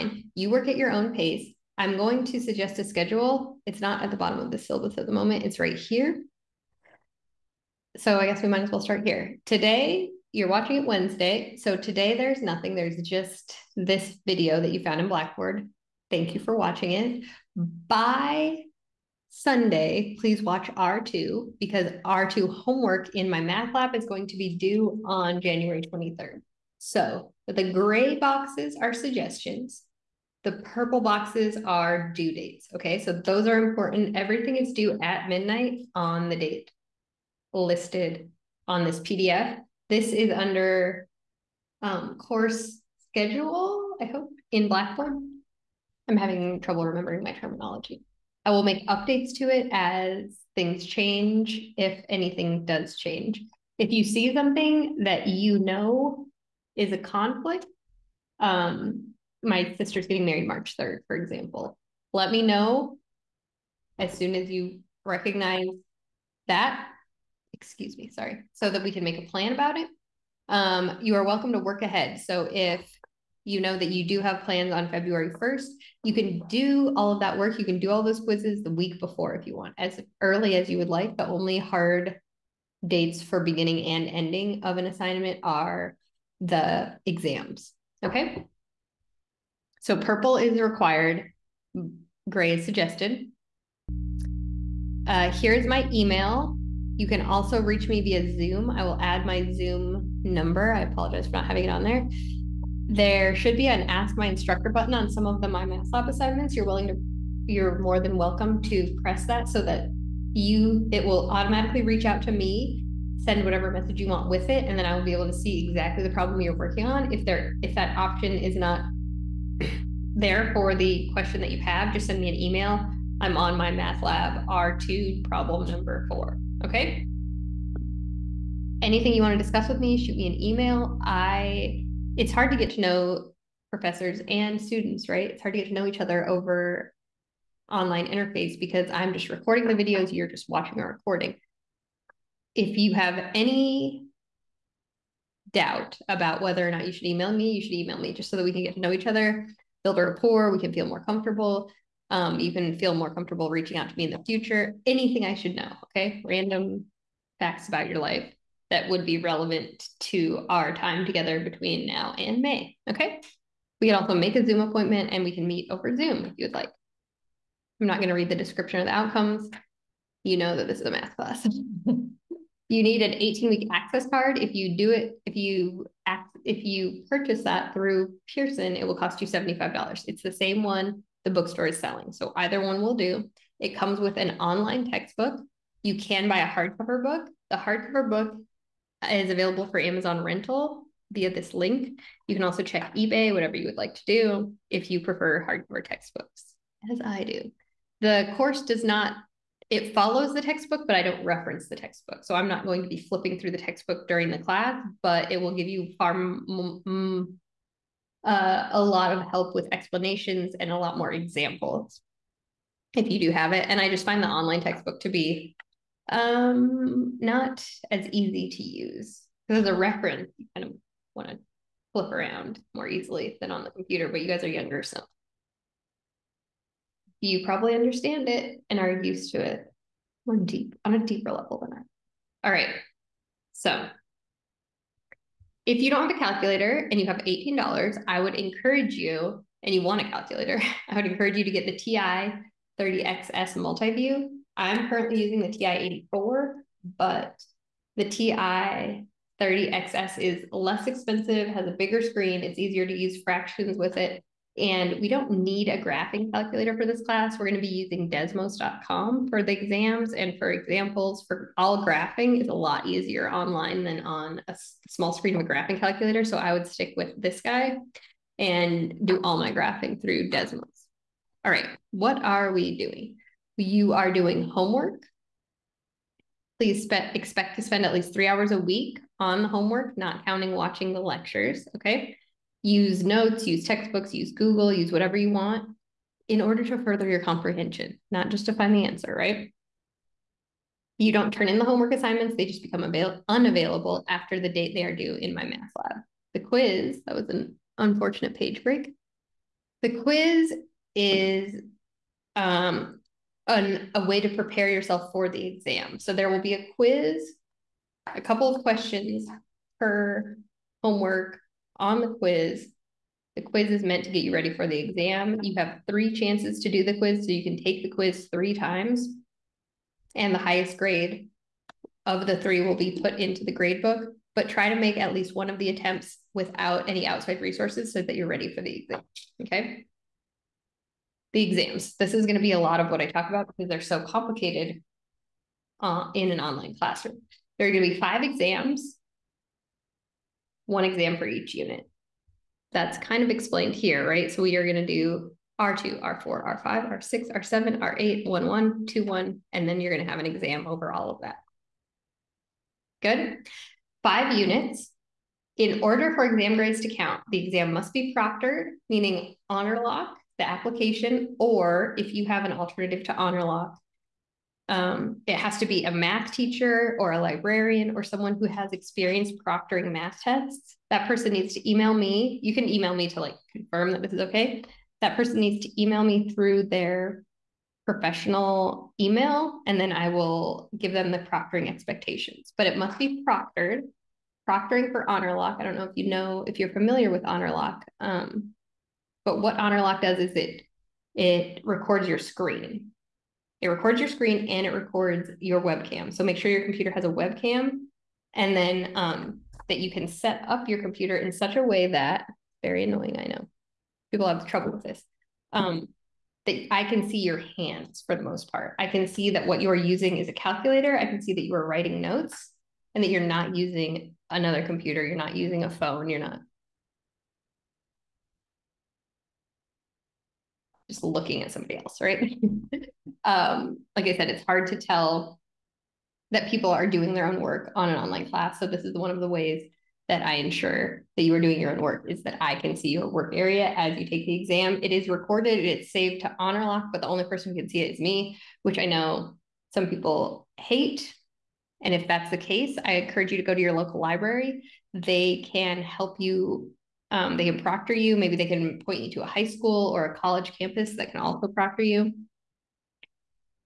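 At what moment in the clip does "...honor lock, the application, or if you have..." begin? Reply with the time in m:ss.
5:59.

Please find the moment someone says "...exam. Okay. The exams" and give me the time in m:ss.
5:28.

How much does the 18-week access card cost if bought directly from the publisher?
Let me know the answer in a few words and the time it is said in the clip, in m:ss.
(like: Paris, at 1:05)
$75, at 2:59.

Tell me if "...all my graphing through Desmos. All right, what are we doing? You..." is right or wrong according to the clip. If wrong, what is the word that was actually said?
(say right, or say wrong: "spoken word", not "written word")
right.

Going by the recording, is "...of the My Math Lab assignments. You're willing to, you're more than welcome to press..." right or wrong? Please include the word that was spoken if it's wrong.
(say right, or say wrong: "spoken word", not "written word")
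right.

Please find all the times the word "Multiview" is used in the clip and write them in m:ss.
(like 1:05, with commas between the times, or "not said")
4:03.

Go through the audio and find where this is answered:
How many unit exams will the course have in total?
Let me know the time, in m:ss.
5:38.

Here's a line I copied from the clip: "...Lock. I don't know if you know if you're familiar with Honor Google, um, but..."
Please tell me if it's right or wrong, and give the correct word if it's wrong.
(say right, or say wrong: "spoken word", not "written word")
wrong: "Lock", not "Google".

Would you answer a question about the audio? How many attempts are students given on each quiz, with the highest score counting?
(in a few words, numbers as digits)
3.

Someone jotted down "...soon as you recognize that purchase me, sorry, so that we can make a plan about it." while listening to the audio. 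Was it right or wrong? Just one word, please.
wrong.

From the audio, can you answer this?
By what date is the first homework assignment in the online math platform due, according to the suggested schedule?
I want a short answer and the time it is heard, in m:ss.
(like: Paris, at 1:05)
January 23rd, at 0:25.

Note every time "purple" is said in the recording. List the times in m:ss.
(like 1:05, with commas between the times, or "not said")
0:30, 1:29.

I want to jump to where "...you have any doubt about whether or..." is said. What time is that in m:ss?
2:22.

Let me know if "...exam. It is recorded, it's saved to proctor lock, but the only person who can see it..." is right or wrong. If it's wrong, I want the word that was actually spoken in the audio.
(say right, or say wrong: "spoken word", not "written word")
wrong: "honor", not "proctor".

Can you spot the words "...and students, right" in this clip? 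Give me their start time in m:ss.
2:14.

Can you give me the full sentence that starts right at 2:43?
We can also make a Zoom appointment and we can meet over Zoom if you would like.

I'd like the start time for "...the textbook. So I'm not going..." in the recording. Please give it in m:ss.
3:21.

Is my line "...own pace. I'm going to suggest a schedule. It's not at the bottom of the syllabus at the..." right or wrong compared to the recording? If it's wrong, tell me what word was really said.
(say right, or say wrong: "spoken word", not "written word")
right.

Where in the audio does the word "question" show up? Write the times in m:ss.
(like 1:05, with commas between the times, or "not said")
2:01, 5:08.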